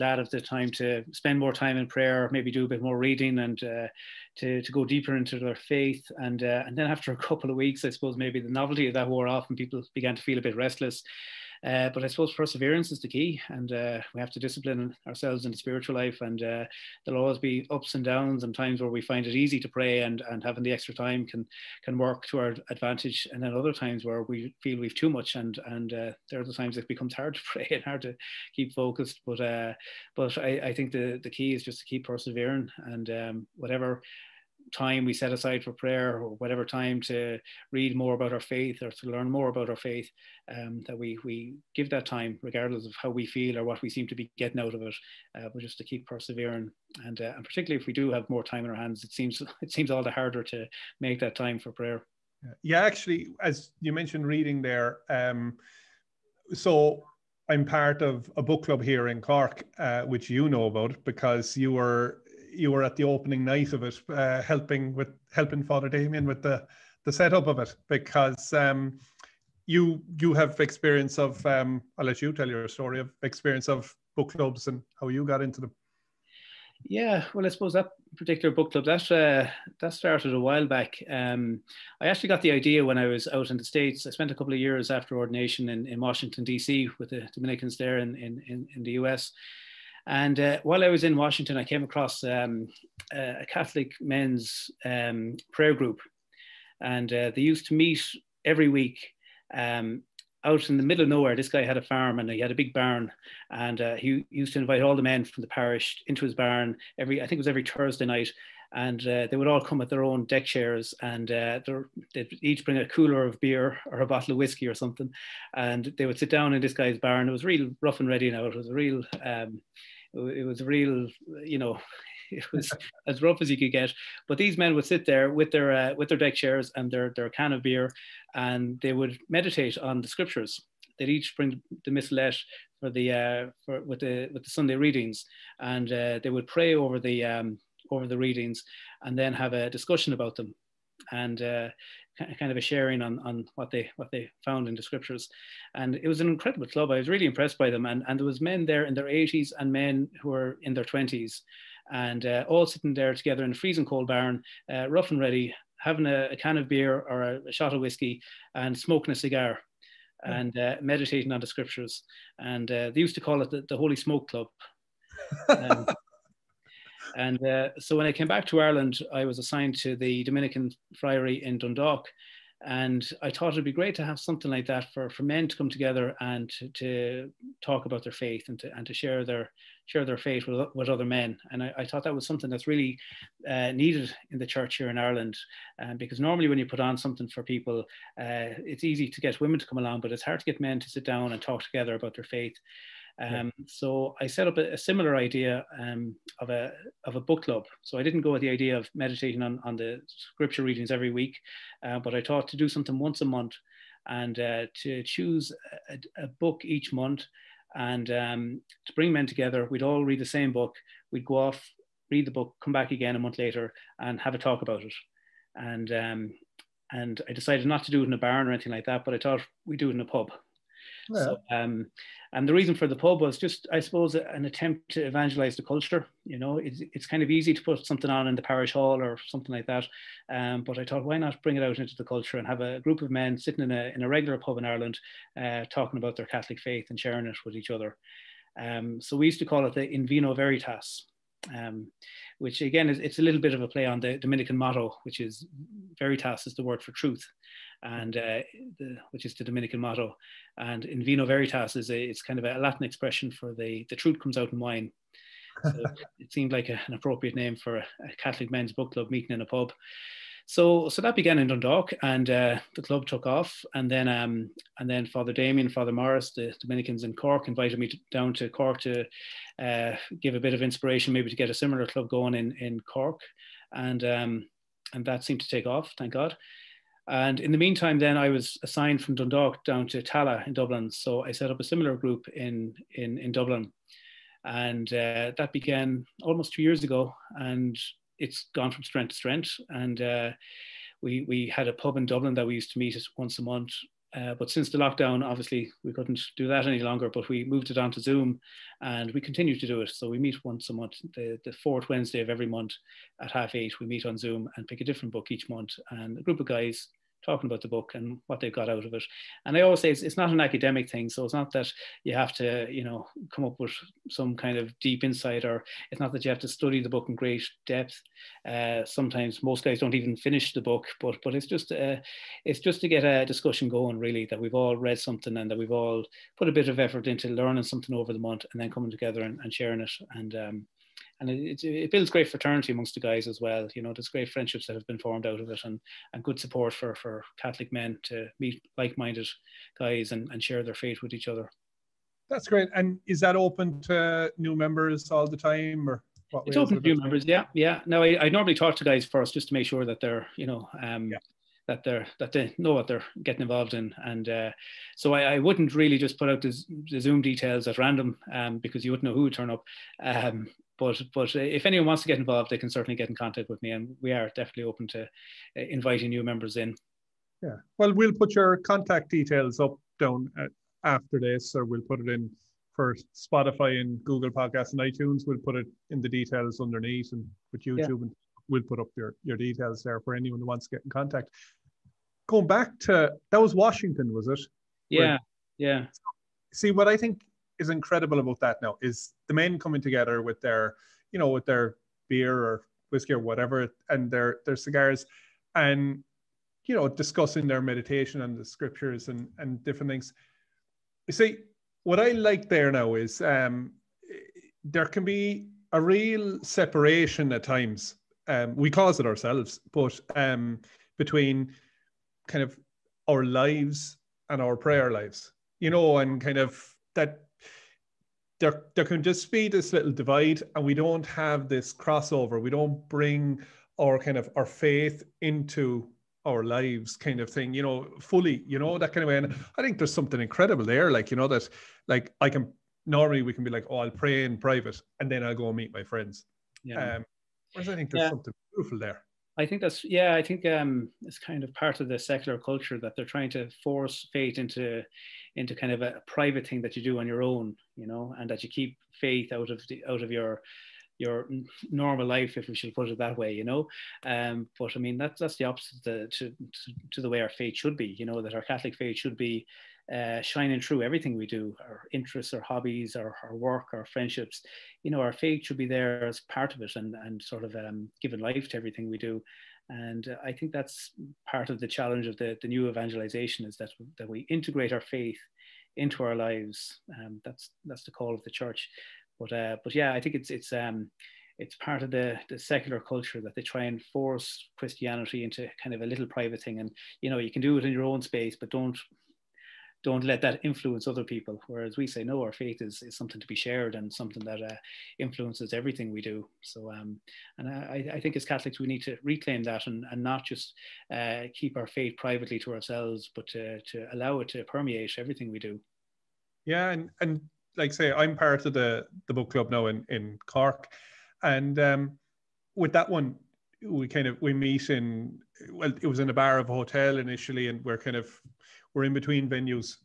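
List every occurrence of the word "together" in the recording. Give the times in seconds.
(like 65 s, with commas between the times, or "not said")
153 s, 175 s, 191 s, 209 s, 328 s, 389 s.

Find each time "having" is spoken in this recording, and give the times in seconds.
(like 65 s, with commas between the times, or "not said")
20 s, 155 s.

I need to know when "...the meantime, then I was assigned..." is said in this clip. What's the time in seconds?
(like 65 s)
277 s.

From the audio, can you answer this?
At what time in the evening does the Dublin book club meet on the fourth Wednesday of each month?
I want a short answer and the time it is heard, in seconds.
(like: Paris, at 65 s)
half eight, at 303 s.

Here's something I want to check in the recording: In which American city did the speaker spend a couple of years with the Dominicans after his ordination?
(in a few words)
Washington D.C.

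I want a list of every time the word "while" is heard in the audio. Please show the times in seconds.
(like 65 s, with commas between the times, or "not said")
80 s, 90 s.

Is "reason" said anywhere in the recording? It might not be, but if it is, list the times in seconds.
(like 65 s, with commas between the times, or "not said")
222 s.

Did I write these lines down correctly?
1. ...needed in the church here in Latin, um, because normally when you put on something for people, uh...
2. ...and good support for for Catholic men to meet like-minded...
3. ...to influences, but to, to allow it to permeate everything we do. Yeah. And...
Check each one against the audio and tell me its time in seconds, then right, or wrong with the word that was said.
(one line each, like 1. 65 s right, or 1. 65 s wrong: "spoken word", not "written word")
1. 183 s wrong: "Ireland", not "Latin"
2. 336 s right
3. 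502 s wrong: "ourselves", not "influences".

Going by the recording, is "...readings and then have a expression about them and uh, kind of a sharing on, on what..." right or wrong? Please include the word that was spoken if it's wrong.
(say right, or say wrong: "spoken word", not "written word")
wrong: "discussion", not "expression".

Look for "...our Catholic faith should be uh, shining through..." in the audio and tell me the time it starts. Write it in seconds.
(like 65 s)
458 s.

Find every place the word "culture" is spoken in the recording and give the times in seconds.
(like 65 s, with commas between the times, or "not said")
225 s, 232 s, 442 s, 482 s.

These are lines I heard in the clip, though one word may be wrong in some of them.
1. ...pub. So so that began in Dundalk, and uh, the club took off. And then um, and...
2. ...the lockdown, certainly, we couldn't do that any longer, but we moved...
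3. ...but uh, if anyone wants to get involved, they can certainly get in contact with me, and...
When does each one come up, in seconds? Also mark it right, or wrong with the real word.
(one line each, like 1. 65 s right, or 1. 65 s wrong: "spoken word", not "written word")
1. 259 s right
2. 294 s wrong: "obviously", not "certainly"
3. 361 s right.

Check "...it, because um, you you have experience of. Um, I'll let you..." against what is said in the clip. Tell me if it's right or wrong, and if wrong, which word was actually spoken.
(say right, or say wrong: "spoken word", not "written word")
right.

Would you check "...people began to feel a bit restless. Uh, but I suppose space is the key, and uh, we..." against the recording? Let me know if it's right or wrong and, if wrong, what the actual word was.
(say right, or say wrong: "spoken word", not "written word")
wrong: "perseverance", not "space".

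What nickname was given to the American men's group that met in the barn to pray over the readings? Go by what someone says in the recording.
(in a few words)
The Holy Smoke Club.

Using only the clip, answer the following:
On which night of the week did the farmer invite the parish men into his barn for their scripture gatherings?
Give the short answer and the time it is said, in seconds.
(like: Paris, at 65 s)
Thursday, at 107 s.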